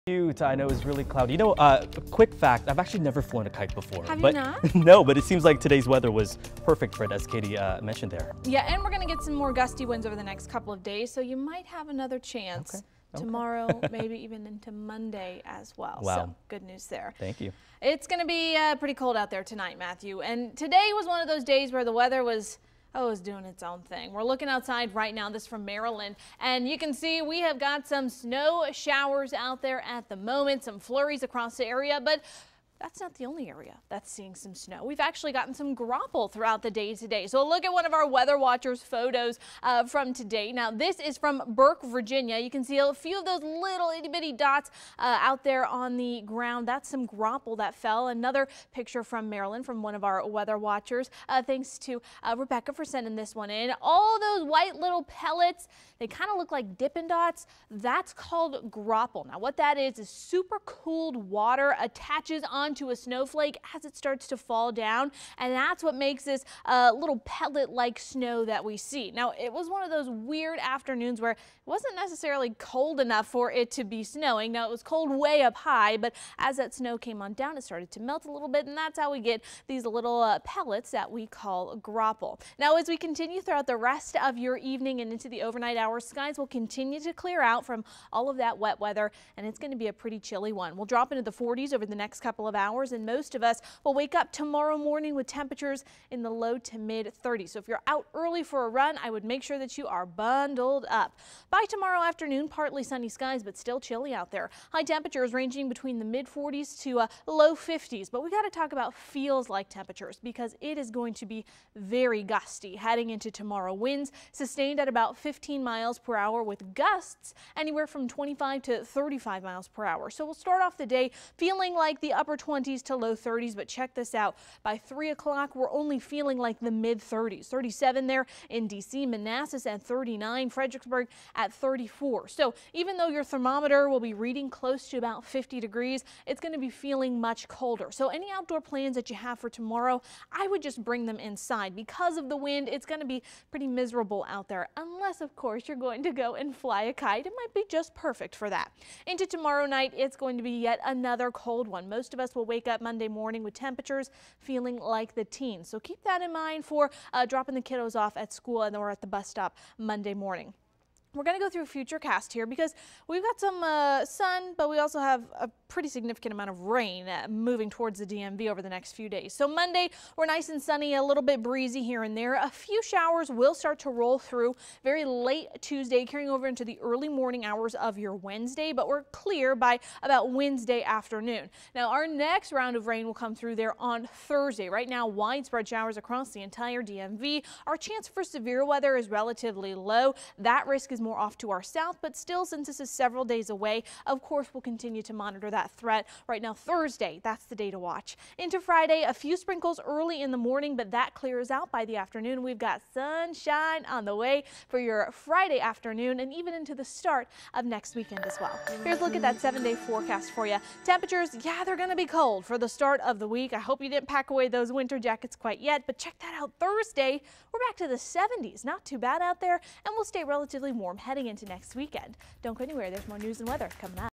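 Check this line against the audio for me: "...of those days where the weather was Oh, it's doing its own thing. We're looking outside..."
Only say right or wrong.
right.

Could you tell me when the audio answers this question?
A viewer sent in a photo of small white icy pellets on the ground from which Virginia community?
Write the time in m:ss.
0:41.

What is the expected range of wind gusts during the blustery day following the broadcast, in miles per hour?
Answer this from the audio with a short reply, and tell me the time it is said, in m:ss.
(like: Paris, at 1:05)
25 to 35, at 1:58.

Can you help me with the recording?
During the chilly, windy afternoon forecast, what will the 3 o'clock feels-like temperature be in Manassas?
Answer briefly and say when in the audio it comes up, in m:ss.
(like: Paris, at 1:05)
39, at 2:09.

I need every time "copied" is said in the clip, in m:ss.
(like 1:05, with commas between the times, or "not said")
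not said.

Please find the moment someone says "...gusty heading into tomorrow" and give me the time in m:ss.
1:52.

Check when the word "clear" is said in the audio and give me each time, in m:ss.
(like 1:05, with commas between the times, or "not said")
1:27, 2:59, 3:21.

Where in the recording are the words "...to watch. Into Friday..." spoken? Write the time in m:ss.
3:17.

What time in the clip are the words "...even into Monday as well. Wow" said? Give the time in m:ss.
0:14.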